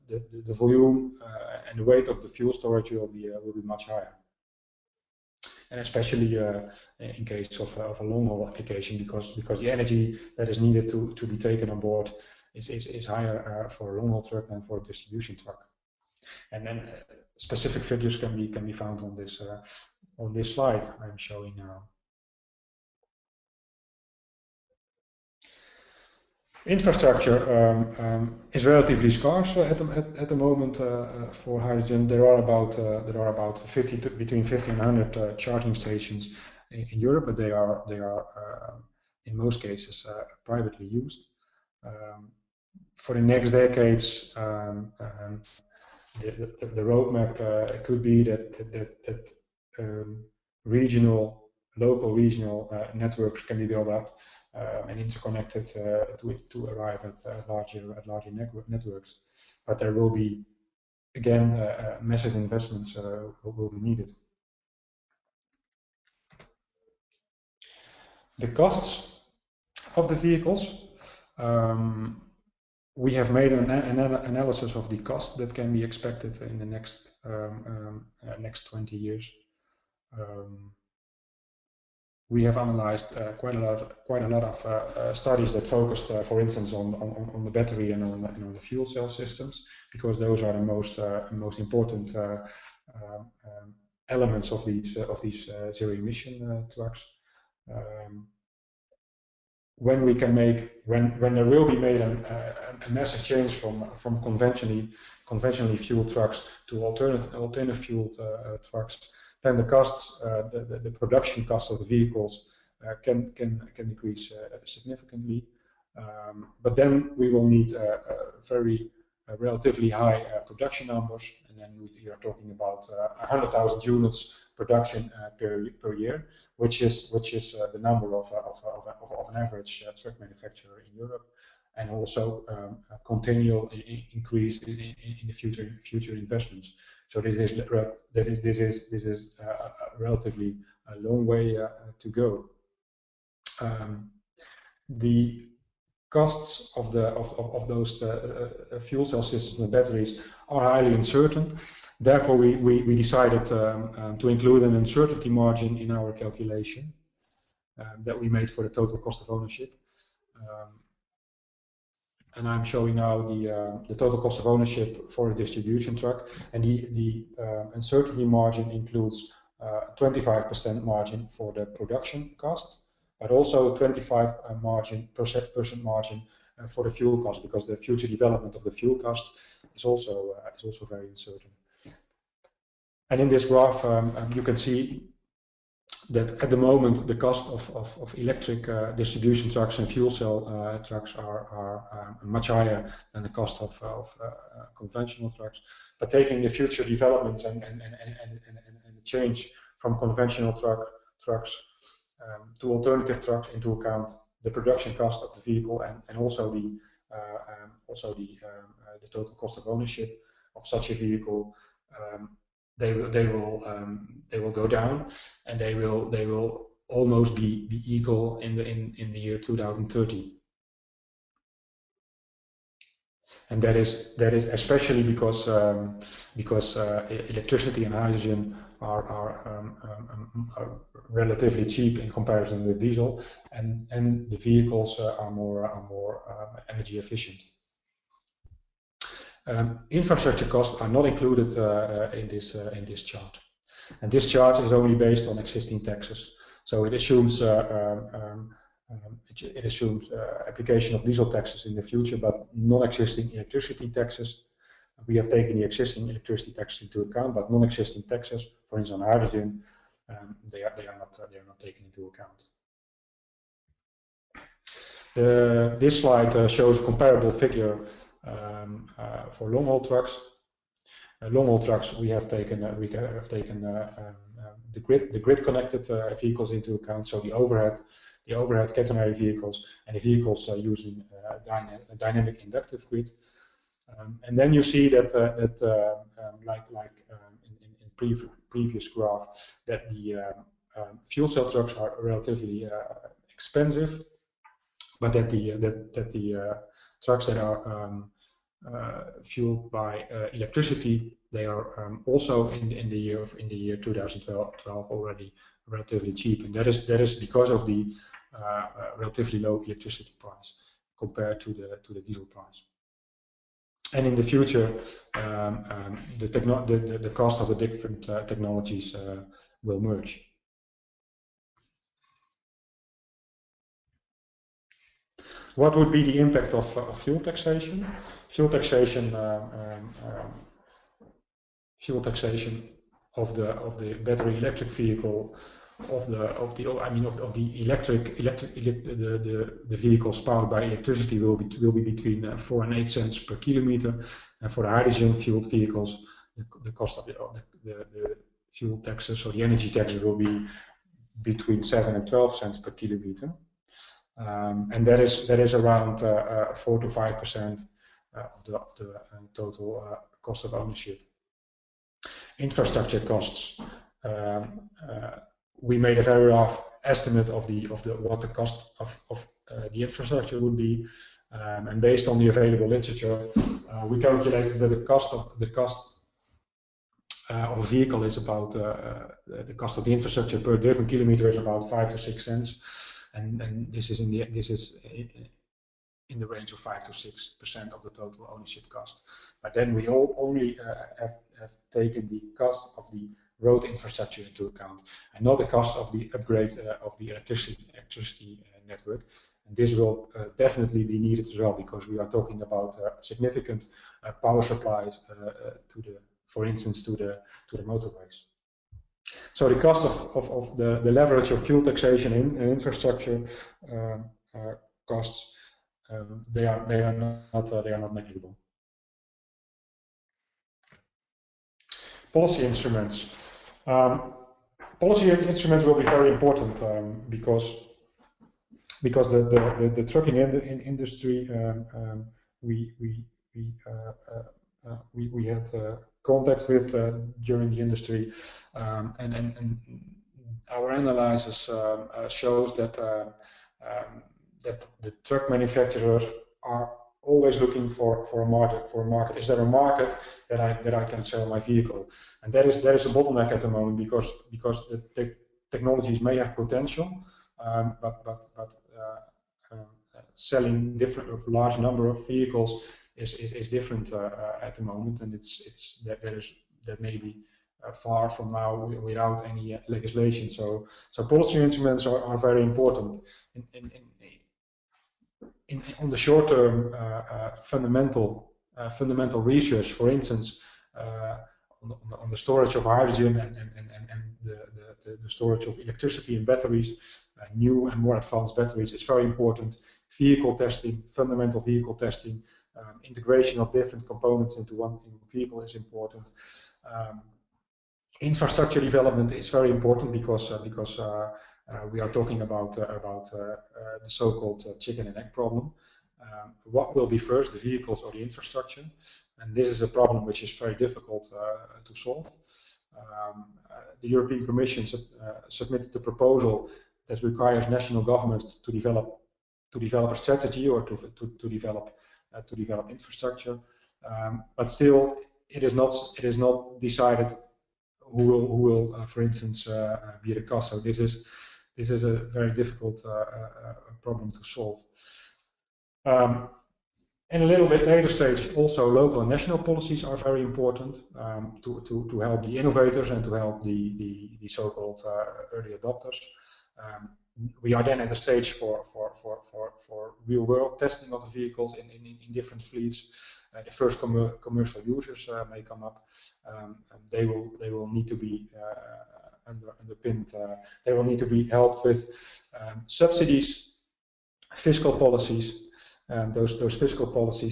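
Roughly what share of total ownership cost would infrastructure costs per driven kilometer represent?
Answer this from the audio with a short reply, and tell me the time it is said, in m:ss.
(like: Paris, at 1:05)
5 to 6 percent, at 6:26.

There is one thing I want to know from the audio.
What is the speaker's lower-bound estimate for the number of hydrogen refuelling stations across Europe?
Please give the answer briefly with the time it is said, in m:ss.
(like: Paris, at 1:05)
50, at 0:34.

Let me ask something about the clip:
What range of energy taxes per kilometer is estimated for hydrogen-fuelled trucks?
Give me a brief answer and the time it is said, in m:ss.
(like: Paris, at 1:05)
7 to 12 cents, at 5:51.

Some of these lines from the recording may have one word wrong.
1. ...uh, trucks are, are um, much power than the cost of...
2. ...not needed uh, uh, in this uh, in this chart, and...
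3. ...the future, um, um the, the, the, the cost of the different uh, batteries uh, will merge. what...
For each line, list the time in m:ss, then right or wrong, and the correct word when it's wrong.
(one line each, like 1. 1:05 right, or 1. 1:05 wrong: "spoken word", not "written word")
1. 3:10 wrong: "higher", not "power"
2. 4:00 wrong: "included", not "needed"
3. 5:14 wrong: "technologies", not "batteries".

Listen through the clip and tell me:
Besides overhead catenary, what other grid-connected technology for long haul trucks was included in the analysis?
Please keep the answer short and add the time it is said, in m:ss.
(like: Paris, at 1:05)
dynamic inductive grid, at 4:41.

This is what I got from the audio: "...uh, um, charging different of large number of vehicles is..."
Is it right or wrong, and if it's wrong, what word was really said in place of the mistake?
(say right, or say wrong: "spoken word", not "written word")
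wrong: "selling", not "charging".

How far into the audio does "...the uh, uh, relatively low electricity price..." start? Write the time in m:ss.
5:07.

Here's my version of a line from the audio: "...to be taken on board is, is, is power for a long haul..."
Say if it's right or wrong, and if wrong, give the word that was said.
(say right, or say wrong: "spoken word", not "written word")
wrong: "higher", not "power".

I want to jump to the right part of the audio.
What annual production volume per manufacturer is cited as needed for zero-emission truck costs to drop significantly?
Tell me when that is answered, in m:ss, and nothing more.
2:03.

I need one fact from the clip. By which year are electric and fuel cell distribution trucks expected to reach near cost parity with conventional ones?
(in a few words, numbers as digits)
2030.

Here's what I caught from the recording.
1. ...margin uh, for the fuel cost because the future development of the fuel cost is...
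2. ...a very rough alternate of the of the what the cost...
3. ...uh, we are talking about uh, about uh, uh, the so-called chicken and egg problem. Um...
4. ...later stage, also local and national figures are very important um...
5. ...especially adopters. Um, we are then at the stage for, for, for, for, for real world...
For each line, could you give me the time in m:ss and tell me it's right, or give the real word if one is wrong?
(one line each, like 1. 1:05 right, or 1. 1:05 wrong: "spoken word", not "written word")
1. 2:55 right
2. 6:05 wrong: "estimate", not "alternate"
3. 8:21 right
4. 8:57 wrong: "policies", not "figures"
5. 9:05 wrong: "early", not "especially".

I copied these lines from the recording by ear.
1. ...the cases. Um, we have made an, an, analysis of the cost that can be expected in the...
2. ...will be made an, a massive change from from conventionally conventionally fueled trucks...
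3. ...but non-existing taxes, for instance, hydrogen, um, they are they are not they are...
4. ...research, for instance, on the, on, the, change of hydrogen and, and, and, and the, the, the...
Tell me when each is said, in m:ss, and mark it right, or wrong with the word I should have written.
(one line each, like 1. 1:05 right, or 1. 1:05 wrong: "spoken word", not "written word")
1. 1:10 wrong: "vehicles", not "cases"
2. 1:41 right
3. 4:17 right
4. 7:59 wrong: "storage", not "change".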